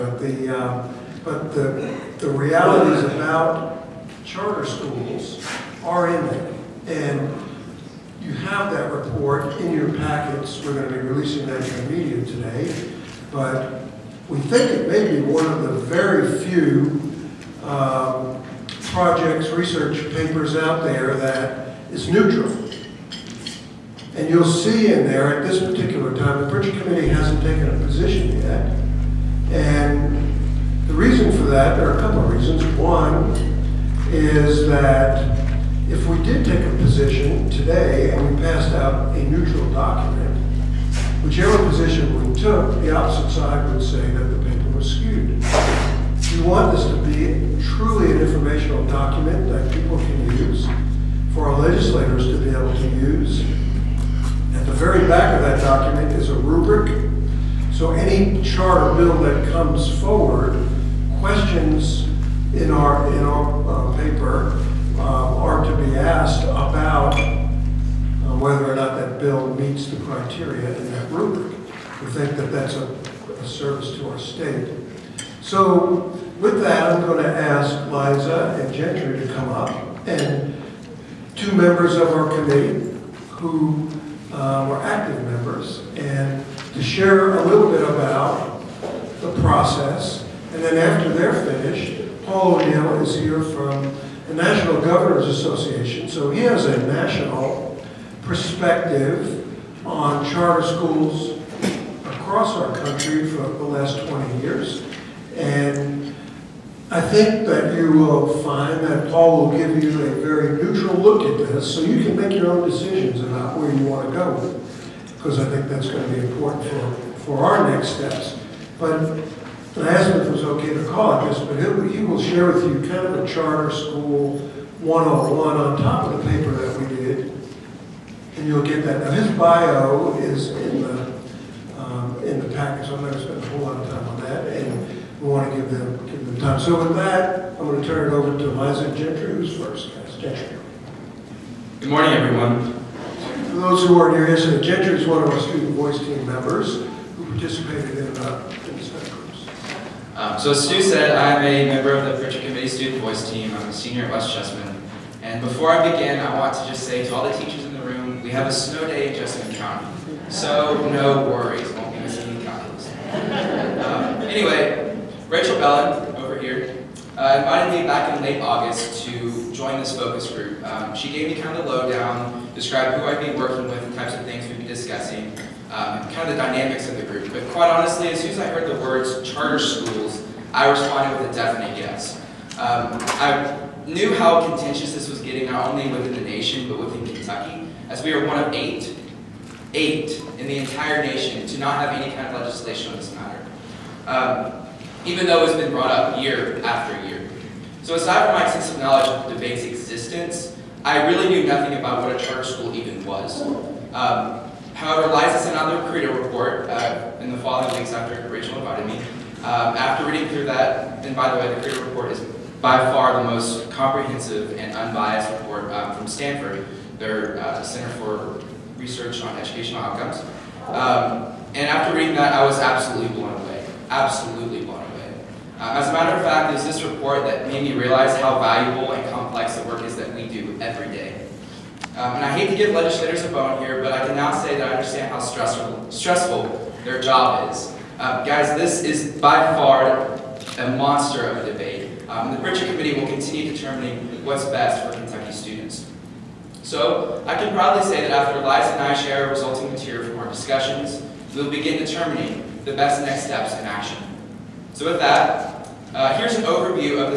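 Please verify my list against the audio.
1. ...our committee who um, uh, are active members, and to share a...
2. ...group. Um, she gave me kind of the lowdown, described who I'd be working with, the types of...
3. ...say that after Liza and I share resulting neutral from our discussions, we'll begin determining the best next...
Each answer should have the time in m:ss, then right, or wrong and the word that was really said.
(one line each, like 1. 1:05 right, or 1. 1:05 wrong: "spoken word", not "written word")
1. 1:22 right
2. 2:50 right
3. 4:07 wrong: "material", not "neutral".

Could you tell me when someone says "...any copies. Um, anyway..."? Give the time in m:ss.
2:42.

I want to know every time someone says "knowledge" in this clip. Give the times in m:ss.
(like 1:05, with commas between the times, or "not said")
3:18.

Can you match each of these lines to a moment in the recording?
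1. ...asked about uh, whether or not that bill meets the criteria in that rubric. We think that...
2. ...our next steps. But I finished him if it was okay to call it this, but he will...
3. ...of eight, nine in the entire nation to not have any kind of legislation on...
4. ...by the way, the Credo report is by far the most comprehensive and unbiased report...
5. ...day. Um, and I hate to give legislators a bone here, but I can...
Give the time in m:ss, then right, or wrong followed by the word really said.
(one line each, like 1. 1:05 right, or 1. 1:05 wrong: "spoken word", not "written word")
1. 1:05 right
2. 1:57 wrong: "asked", not "finished"
3. 3:08 wrong: "eight", not "nine"
4. 3:31 right
5. 3:50 right.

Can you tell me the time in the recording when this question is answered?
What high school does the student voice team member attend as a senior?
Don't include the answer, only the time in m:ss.
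2:34.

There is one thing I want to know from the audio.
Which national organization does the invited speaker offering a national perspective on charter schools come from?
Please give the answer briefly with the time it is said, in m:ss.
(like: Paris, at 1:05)
National Governors Association, at 1:34.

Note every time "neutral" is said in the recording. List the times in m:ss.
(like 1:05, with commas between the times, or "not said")
0:22, 0:39, 1:50.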